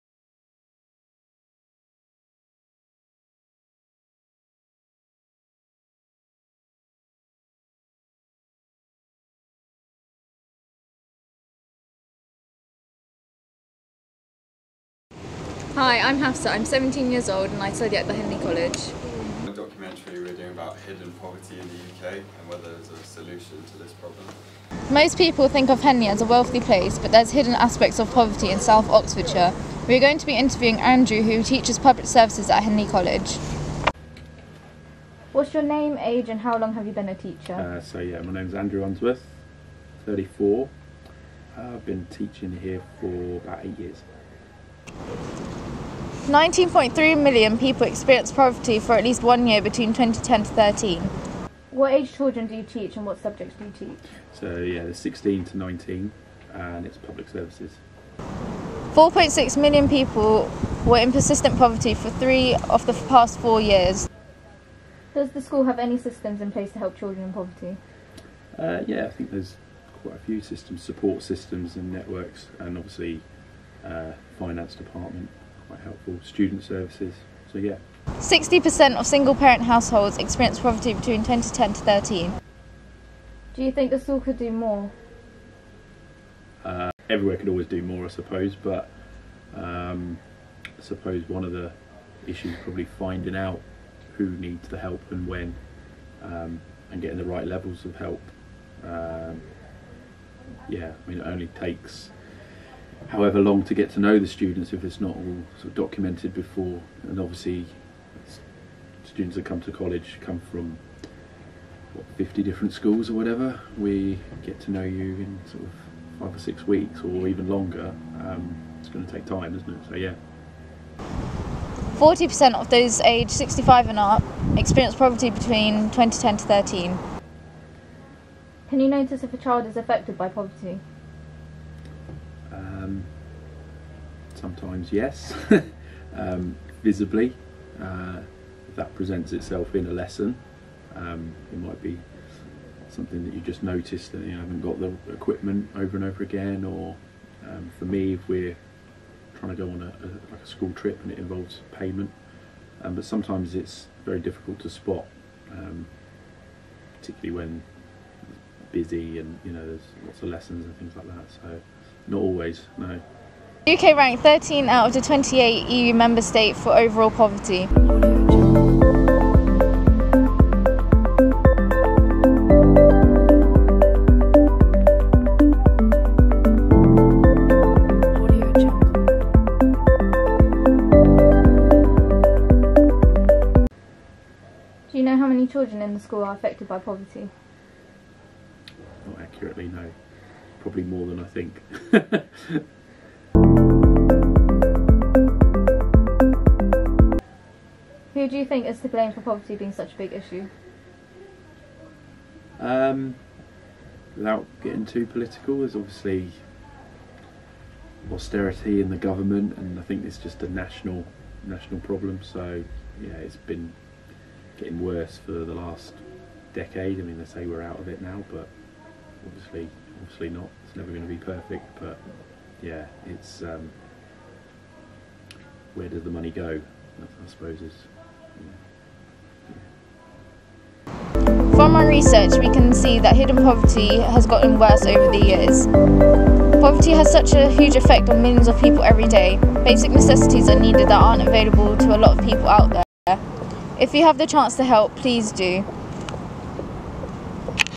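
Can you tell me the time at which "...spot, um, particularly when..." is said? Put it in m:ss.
2:34.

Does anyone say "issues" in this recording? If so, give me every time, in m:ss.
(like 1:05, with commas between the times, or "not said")
1:32, 3:20.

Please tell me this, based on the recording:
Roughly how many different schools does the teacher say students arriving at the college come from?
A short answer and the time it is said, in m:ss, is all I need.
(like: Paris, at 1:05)
50, at 1:52.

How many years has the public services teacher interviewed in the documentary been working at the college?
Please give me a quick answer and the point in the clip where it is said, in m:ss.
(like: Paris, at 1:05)
8, at 0:43.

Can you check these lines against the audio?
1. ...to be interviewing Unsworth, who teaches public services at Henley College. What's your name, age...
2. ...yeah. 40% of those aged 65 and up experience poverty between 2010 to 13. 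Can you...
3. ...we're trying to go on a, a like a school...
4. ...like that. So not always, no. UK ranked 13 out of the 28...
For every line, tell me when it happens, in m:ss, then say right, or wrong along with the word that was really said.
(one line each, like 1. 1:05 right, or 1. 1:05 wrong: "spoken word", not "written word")
1. 0:30 wrong: "Andrew", not "Unsworth"
2. 1:59 right
3. 2:28 right
4. 2:40 right.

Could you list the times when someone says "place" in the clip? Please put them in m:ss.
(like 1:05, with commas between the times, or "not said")
0:26, 1:06.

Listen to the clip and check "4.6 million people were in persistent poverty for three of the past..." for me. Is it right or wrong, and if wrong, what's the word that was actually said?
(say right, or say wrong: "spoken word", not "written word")
right.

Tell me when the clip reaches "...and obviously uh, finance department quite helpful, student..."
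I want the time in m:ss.
1:12.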